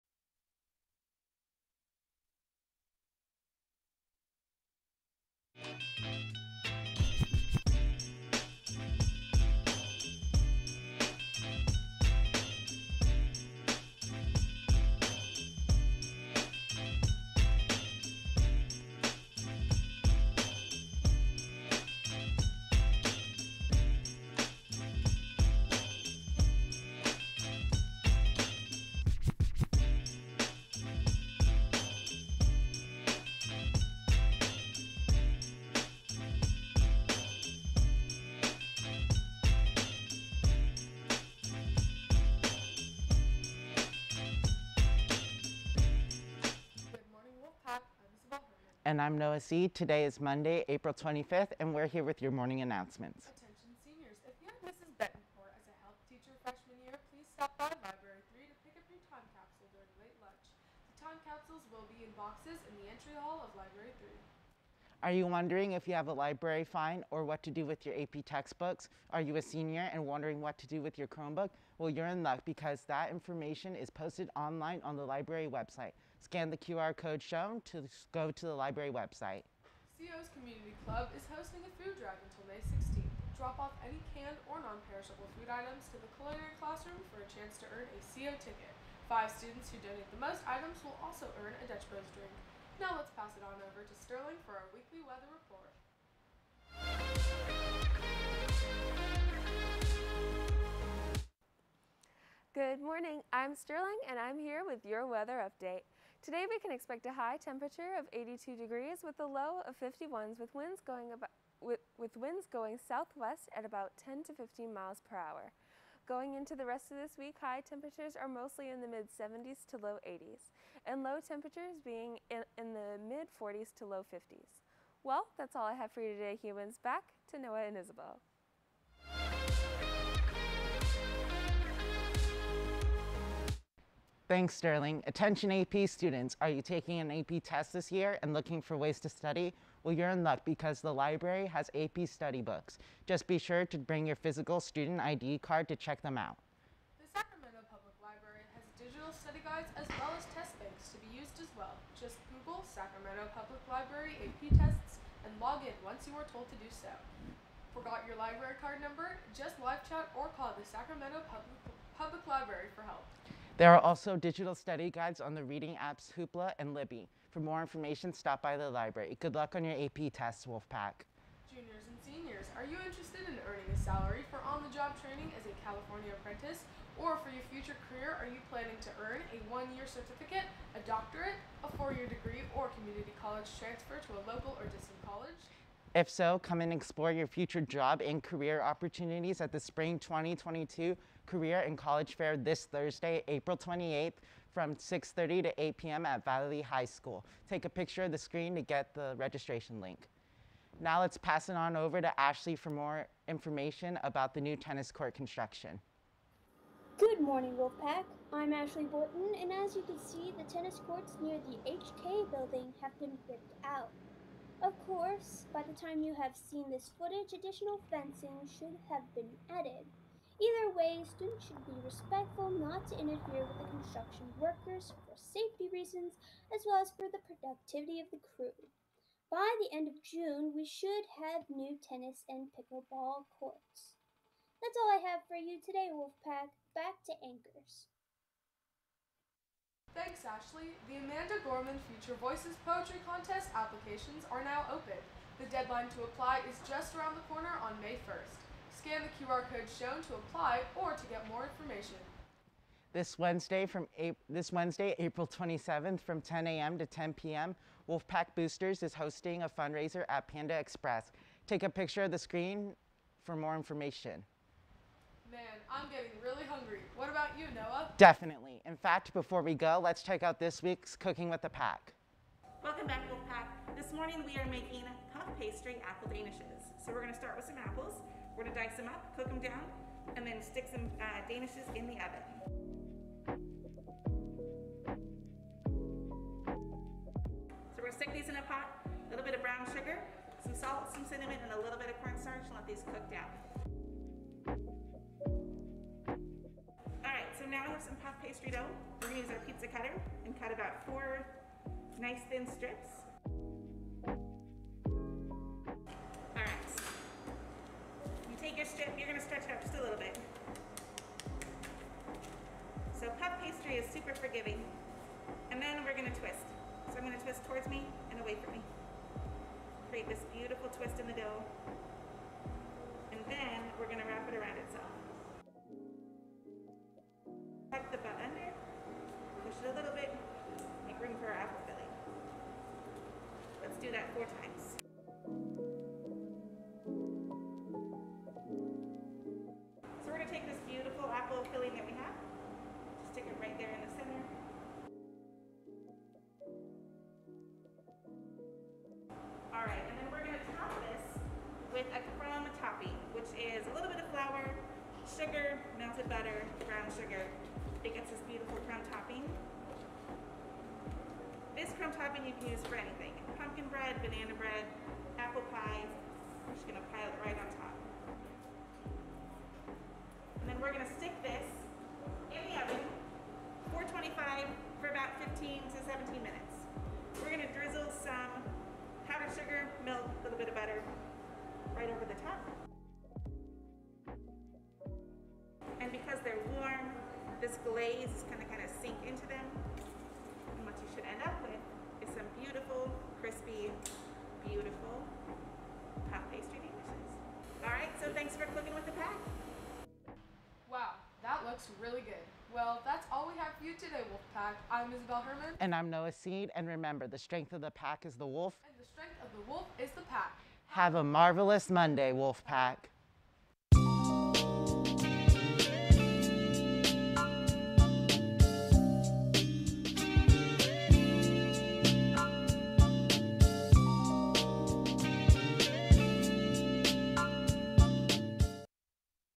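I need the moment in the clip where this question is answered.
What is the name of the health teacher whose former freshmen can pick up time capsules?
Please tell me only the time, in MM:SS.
00:54.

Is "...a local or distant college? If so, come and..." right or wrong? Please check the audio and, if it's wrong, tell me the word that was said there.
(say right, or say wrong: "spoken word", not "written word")
right.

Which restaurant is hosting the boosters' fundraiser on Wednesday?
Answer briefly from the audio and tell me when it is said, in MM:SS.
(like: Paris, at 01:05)
Panda Express, at 04:20.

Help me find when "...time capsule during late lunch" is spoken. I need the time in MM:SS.
00:59.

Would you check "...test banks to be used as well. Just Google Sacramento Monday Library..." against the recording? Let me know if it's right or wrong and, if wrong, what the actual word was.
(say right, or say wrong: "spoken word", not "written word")
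wrong: "Public", not "Monday".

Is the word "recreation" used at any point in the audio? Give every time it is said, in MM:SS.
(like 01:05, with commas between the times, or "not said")
not said.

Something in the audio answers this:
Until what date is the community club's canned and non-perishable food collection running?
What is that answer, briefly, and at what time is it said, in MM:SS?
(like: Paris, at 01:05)
May 16th, at 01:22.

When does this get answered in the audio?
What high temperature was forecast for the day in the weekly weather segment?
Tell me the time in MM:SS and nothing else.
01:48.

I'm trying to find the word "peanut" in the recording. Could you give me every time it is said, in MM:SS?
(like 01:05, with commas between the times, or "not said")
not said.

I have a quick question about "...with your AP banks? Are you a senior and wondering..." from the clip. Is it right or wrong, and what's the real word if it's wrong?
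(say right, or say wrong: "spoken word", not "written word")
wrong: "textbooks", not "banks".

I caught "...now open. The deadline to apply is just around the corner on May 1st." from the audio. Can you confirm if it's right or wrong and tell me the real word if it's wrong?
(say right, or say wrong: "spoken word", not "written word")
right.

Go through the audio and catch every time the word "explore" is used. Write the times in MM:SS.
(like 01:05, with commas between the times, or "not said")
03:06.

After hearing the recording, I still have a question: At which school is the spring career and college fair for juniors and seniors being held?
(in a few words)
Valley High School.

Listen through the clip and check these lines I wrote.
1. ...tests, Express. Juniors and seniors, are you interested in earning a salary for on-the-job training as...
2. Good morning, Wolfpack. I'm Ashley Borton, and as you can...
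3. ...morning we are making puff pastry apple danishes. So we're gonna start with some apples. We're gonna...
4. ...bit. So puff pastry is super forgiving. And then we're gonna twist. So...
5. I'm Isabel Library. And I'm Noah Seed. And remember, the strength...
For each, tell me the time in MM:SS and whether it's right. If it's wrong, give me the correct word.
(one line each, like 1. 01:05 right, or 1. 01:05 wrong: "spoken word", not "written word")
1. 02:50 wrong: "Wolfpack", not "Express"
2. 03:26 right
3. 04:33 right
4. 05:09 right
5. 06:44 wrong: "Herman", not "Library".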